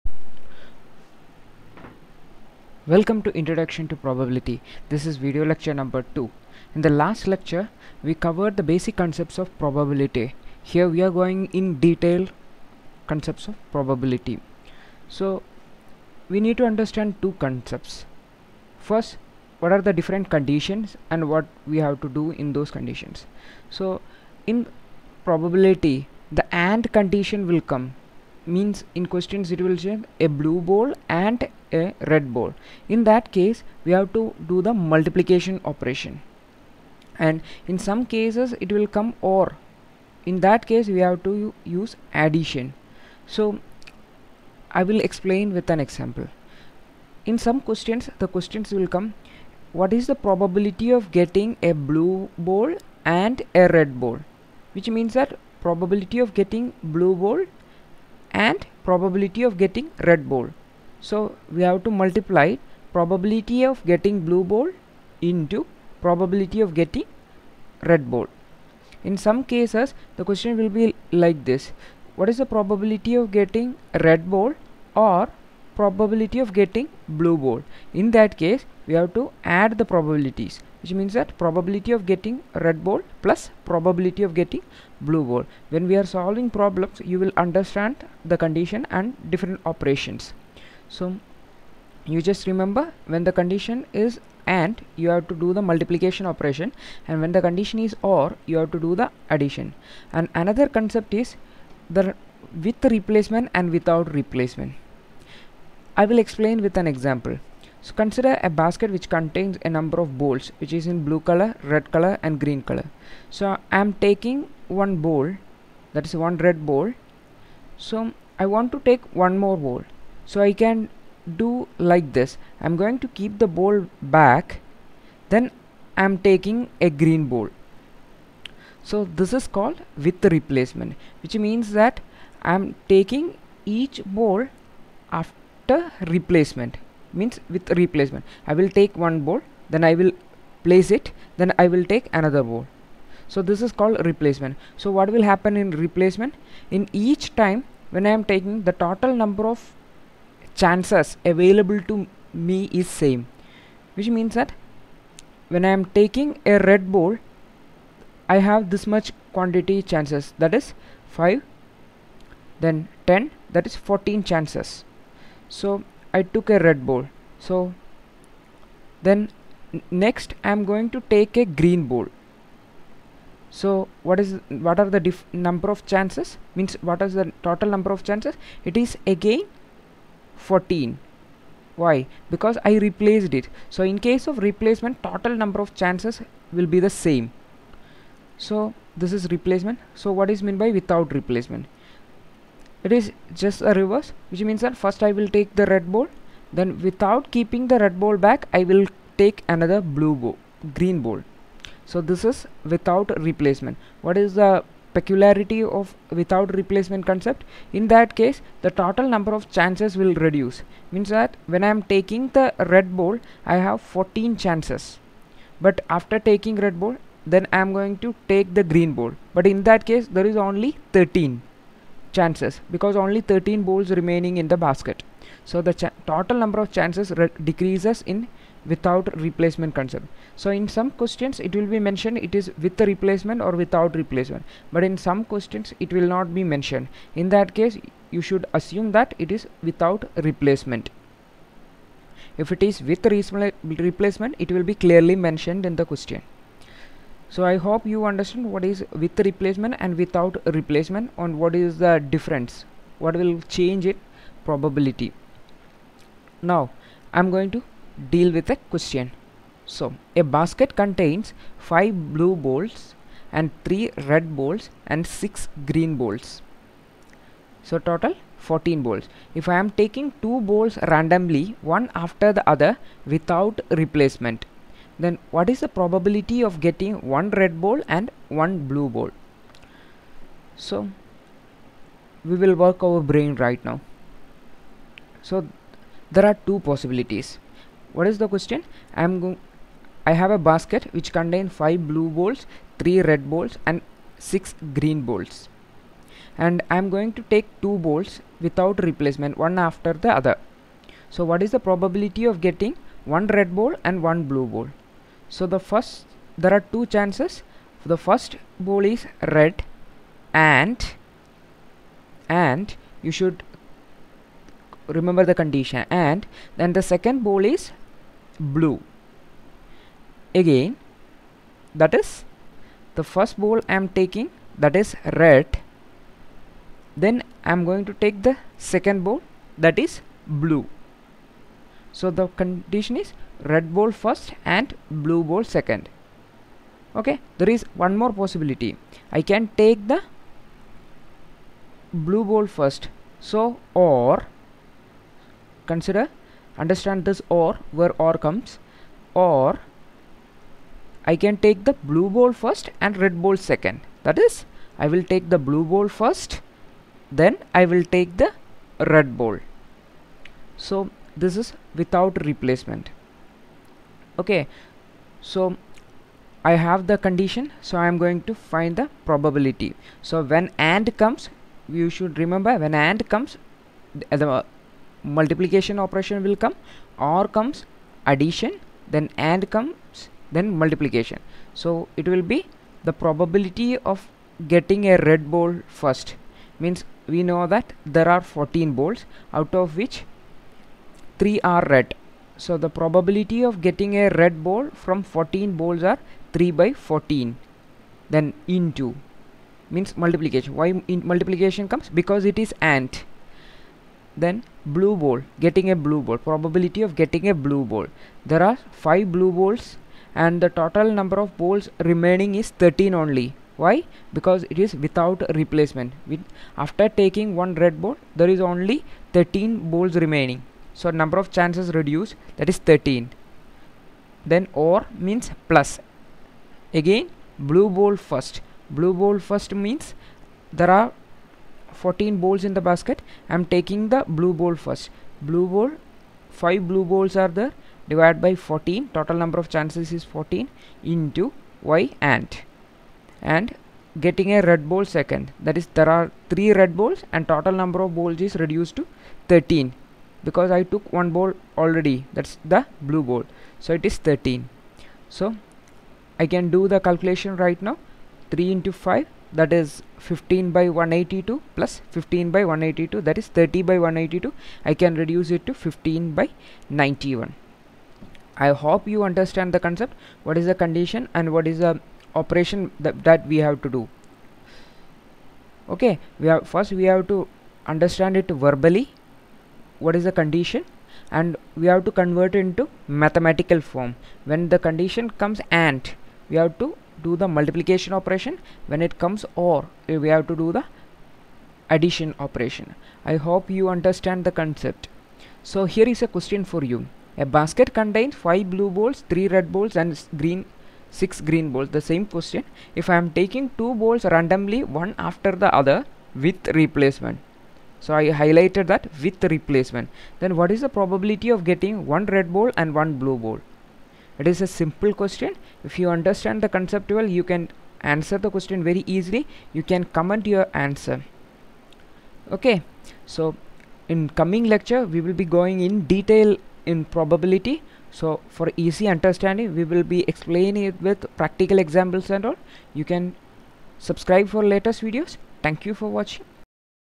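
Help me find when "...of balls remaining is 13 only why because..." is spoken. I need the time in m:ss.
6:51.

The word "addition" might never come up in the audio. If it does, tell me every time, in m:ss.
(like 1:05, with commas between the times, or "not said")
0:42, 1:39, 6:18, 8:11.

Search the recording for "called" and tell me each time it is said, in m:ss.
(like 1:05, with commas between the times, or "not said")
2:09, 2:23.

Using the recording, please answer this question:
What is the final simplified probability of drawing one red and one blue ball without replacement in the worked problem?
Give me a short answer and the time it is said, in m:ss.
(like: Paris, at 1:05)
15/91, at 7:45.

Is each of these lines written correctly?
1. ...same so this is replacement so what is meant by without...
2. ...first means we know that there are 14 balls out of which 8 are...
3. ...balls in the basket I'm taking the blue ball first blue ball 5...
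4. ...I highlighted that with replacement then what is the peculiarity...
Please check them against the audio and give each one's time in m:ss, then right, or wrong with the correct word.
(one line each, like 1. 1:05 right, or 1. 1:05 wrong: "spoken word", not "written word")
1. 3:06 right
2. 6:25 wrong: "3", not "8"
3. 7:12 right
4. 8:27 wrong: "probability", not "peculiarity".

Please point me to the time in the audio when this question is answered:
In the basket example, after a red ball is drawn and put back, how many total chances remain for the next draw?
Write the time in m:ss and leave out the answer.
2:58.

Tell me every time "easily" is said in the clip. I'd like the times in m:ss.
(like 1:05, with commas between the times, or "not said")
8:38.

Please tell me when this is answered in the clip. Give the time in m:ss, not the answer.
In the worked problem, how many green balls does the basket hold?
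4:25.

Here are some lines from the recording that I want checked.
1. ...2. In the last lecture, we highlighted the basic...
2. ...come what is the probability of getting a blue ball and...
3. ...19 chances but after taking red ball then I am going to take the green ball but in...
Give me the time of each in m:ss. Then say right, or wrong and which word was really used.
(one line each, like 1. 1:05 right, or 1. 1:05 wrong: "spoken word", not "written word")
1. 0:06 wrong: "covered", not "highlighted"
2. 0:48 right
3. 3:33 wrong: "14", not "19".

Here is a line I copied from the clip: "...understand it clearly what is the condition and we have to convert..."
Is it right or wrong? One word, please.
wrong.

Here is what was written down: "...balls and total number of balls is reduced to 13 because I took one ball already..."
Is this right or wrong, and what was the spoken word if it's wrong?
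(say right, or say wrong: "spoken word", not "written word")
right.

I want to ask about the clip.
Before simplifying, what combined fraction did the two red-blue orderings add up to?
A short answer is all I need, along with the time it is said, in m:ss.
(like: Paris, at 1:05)
30/182, at 7:43.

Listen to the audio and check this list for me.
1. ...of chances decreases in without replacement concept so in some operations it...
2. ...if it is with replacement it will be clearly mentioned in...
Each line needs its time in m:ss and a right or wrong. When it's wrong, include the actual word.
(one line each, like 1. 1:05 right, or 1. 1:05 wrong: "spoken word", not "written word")
1. 3:46 wrong: "questions", not "operations"
2. 4:02 right.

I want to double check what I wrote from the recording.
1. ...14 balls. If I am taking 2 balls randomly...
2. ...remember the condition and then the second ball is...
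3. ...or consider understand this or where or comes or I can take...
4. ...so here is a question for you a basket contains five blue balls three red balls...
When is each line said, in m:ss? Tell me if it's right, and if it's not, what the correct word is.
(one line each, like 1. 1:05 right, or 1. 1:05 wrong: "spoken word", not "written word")
1. 4:28 right
2. 5:14 right
3. 5:43 right
4. 8:15 right.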